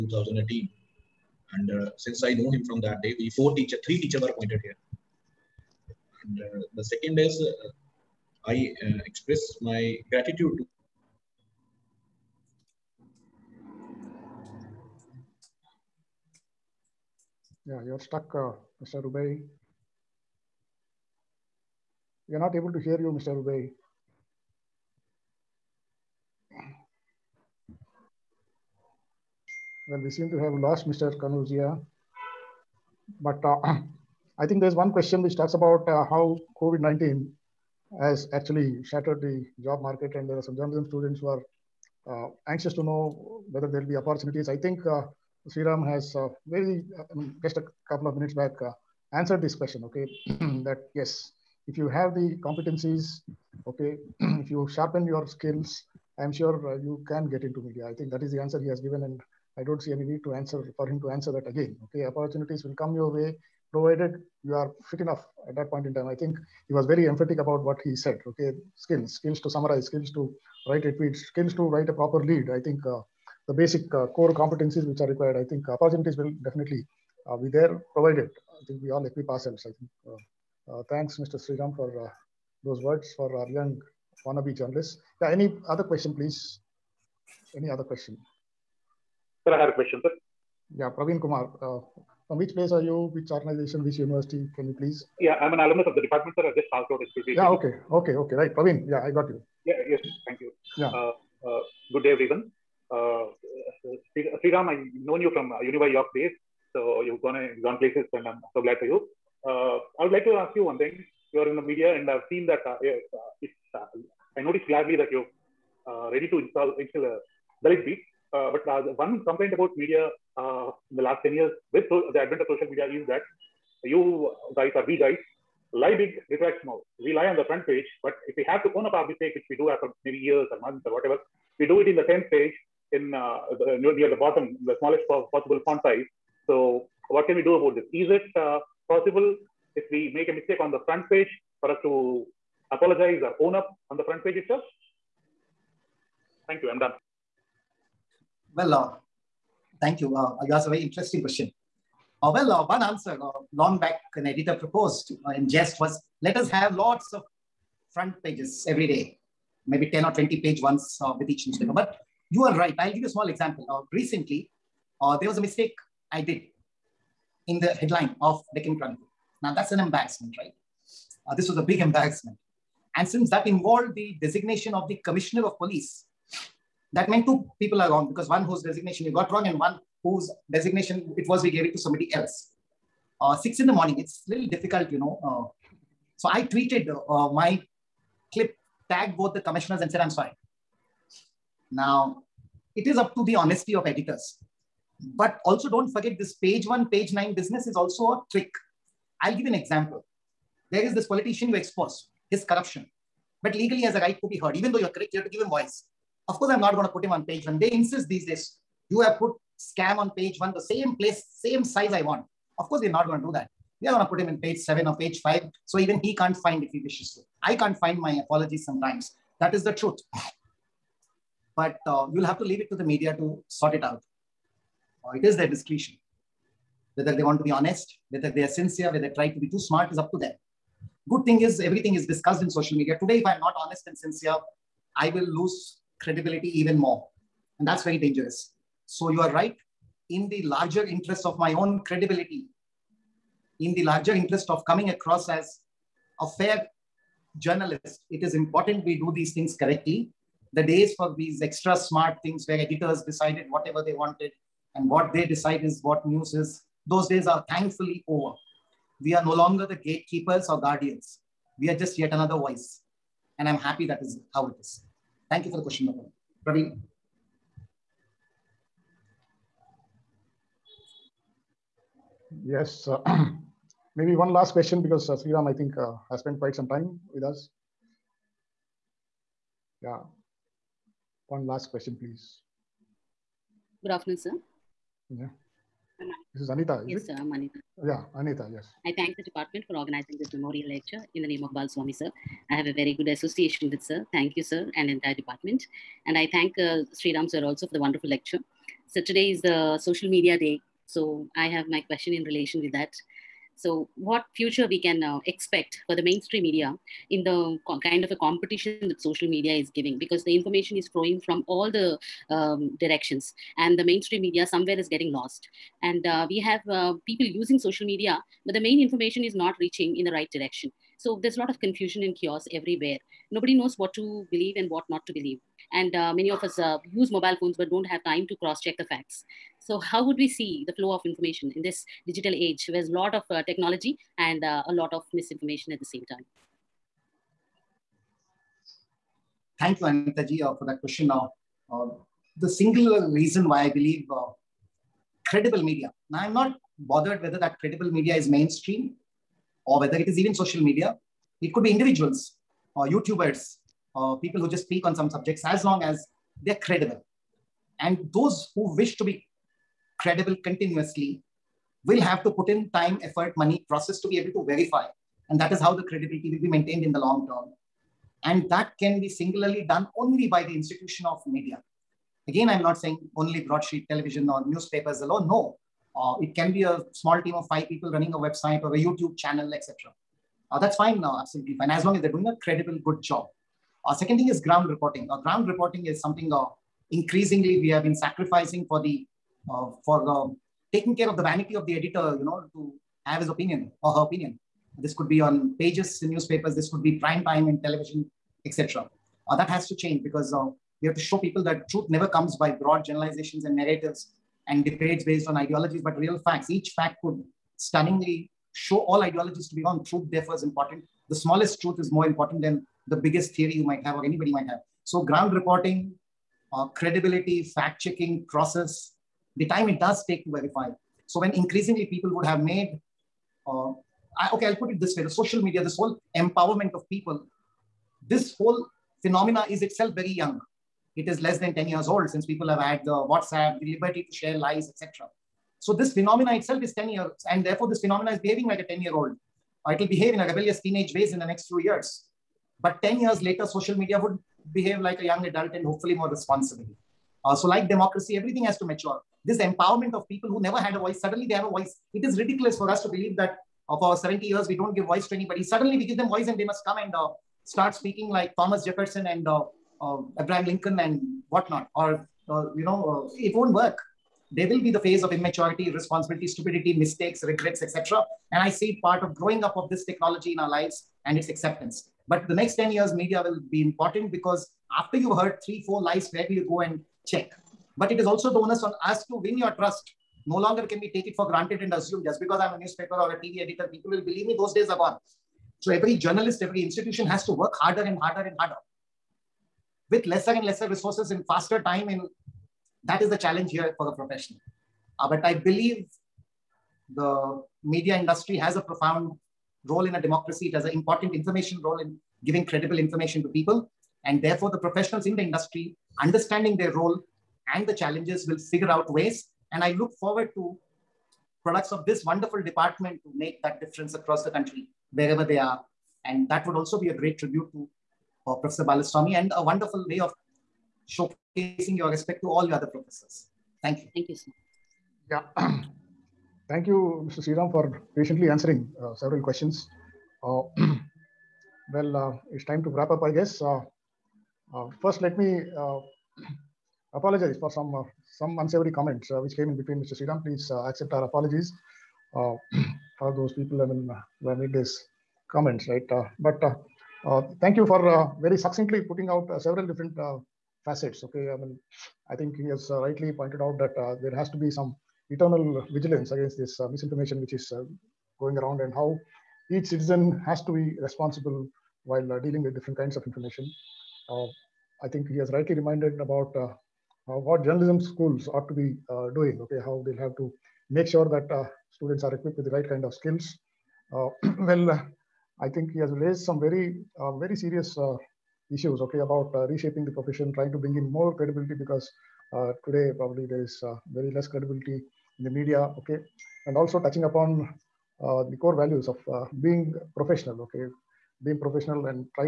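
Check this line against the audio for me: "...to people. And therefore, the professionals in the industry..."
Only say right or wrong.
right.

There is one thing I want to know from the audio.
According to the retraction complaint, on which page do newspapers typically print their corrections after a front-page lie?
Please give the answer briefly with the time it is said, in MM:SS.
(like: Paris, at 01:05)
10th page, at 02:12.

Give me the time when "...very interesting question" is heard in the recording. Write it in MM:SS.
02:30.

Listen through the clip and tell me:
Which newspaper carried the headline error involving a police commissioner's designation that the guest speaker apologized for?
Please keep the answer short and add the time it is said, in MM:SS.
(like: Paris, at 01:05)
Deccan Chronicle, at 02:48.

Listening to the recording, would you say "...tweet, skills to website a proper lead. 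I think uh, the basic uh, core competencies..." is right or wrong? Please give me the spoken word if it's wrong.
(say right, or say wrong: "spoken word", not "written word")
wrong: "write", not "website".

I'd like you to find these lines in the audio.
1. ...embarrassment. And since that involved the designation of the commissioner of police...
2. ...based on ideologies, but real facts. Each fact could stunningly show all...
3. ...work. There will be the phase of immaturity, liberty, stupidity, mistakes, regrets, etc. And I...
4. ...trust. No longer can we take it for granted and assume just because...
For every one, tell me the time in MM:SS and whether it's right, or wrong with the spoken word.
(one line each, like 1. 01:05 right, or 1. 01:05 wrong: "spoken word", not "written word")
1. 02:51 right
2. 06:45 right
3. 07:43 wrong: "irresponsibility", not "liberty"
4. 07:59 right.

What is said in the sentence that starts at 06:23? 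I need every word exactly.
Uh, second thing is ground reporting.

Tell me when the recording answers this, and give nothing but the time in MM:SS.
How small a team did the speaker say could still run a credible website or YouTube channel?
06:17.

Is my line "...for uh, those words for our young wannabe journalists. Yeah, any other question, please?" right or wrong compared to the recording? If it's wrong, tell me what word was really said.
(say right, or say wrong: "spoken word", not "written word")
right.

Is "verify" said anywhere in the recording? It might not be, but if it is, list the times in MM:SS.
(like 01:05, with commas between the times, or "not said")
06:04, 07:00.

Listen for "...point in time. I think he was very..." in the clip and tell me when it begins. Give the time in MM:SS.
01:05.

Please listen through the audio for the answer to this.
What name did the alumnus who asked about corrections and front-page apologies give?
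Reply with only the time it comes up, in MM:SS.
01:30.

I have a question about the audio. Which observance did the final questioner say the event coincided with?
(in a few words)
Social media day.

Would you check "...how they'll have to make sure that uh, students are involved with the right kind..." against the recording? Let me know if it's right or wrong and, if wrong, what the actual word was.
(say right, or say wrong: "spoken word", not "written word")
wrong: "equipped", not "involved".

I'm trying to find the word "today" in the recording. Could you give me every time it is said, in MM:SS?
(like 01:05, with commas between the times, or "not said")
03:52, 04:59, 09:42.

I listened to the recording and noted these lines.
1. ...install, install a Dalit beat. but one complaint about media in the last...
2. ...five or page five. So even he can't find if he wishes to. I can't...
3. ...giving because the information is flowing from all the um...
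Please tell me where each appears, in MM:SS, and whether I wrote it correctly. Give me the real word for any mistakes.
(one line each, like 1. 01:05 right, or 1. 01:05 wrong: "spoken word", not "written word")
1. 01:56 right
2. 03:34 wrong: "seven", not "five"
3. 05:09 right.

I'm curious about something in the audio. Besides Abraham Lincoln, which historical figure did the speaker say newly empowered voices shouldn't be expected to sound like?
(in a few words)
Thomas Jefferson.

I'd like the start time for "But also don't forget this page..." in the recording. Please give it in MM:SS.
03:15.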